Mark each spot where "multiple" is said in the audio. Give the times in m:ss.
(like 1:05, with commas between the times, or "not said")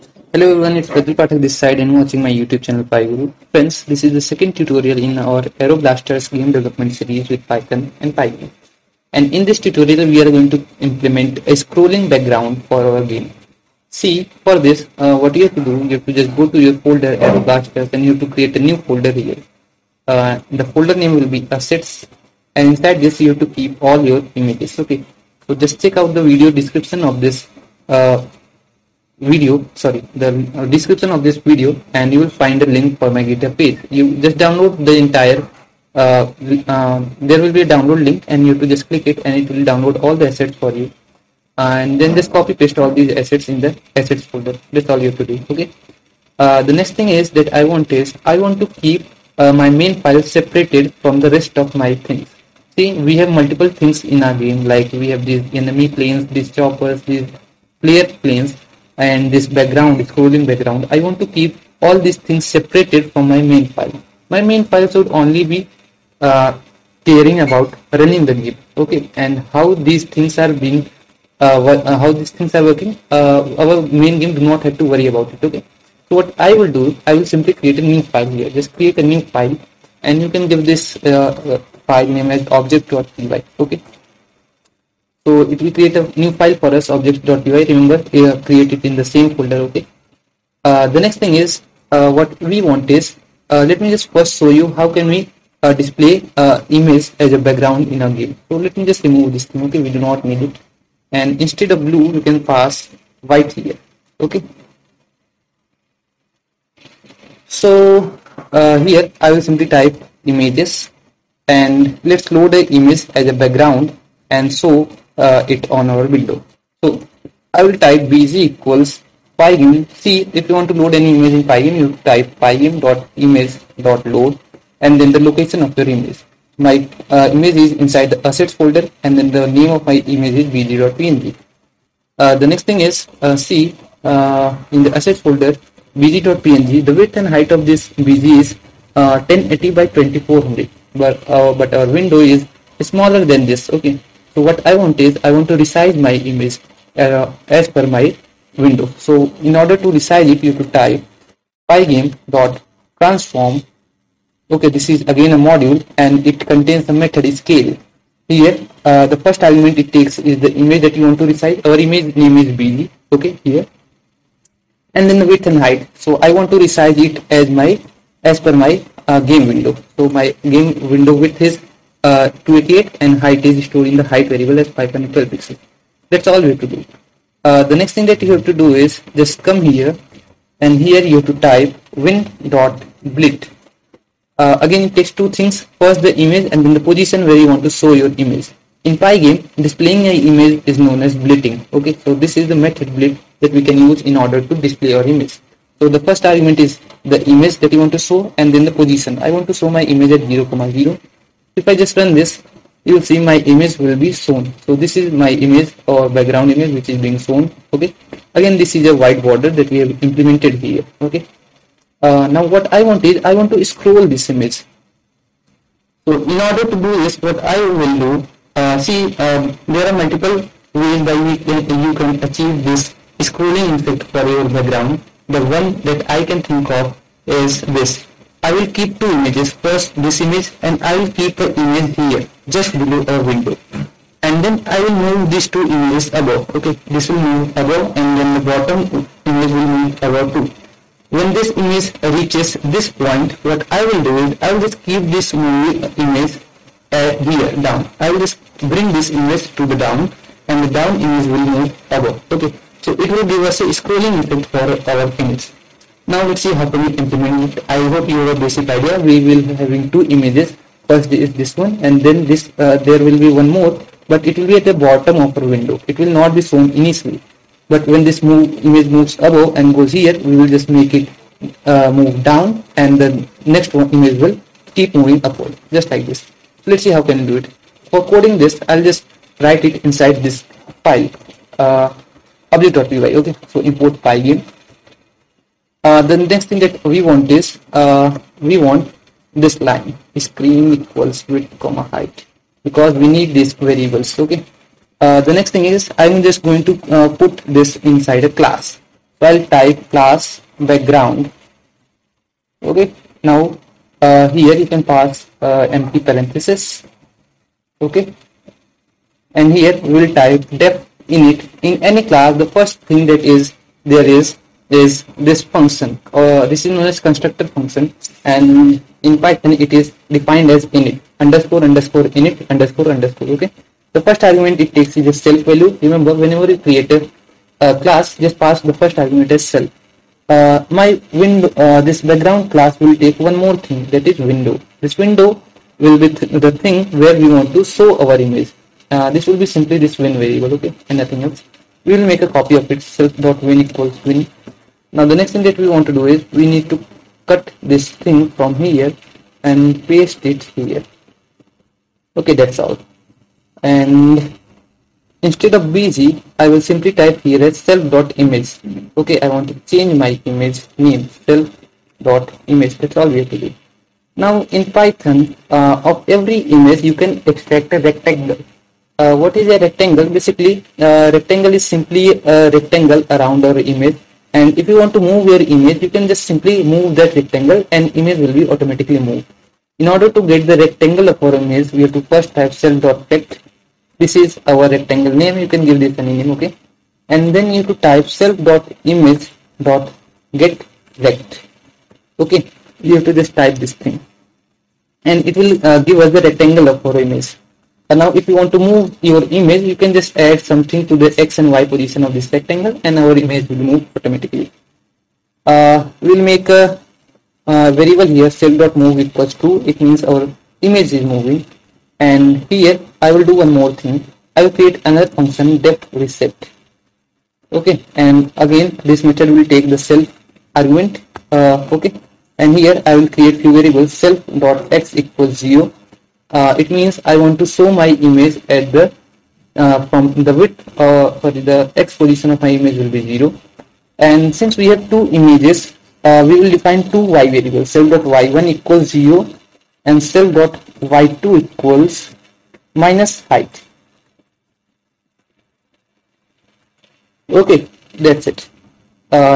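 0:53, 3:39.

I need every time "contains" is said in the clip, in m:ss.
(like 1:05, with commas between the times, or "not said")
2:36.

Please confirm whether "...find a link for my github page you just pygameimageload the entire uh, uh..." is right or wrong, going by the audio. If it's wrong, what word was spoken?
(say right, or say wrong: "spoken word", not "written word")
wrong: "download", not "pygameimageload".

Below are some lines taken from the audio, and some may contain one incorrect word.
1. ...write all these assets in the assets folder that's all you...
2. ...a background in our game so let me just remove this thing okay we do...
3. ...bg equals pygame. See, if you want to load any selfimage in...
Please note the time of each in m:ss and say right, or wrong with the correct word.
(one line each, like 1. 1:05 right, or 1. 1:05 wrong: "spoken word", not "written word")
1. 0:42 wrong: "paste", not "write"
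2. 1:37 right
3. 1:58 wrong: "image", not "selfimage".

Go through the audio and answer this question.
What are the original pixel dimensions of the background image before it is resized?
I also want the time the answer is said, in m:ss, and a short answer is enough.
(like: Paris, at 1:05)
1080 by 2400, at 2:18.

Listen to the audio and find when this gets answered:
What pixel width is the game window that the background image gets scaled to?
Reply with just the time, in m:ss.
2:52.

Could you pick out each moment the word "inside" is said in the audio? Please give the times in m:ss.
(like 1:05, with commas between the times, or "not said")
0:22, 2:07, 4:39, 4:57.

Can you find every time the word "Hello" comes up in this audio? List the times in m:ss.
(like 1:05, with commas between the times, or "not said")
0:00.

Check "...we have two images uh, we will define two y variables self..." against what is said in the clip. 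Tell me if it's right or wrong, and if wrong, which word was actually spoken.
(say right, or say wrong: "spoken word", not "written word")
right.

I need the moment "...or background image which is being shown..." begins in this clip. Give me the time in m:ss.
3:25.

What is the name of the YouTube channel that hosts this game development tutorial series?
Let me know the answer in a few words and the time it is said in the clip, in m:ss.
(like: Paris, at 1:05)
PyGuru, at 0:02.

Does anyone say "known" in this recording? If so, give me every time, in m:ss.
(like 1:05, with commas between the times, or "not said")
3:10, 5:16.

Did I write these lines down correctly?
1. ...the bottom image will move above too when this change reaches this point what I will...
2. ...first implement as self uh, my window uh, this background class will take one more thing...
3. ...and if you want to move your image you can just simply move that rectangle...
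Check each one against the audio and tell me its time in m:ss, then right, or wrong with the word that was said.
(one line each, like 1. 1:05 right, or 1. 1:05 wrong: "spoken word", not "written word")
1. 3:58 wrong: "image", not "change"
2. 5:28 wrong: "argument", not "implement"
3. 6:14 right.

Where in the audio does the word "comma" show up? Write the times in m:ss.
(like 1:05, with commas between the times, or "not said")
3:20, 4:51.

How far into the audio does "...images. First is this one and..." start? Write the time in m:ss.
4:20.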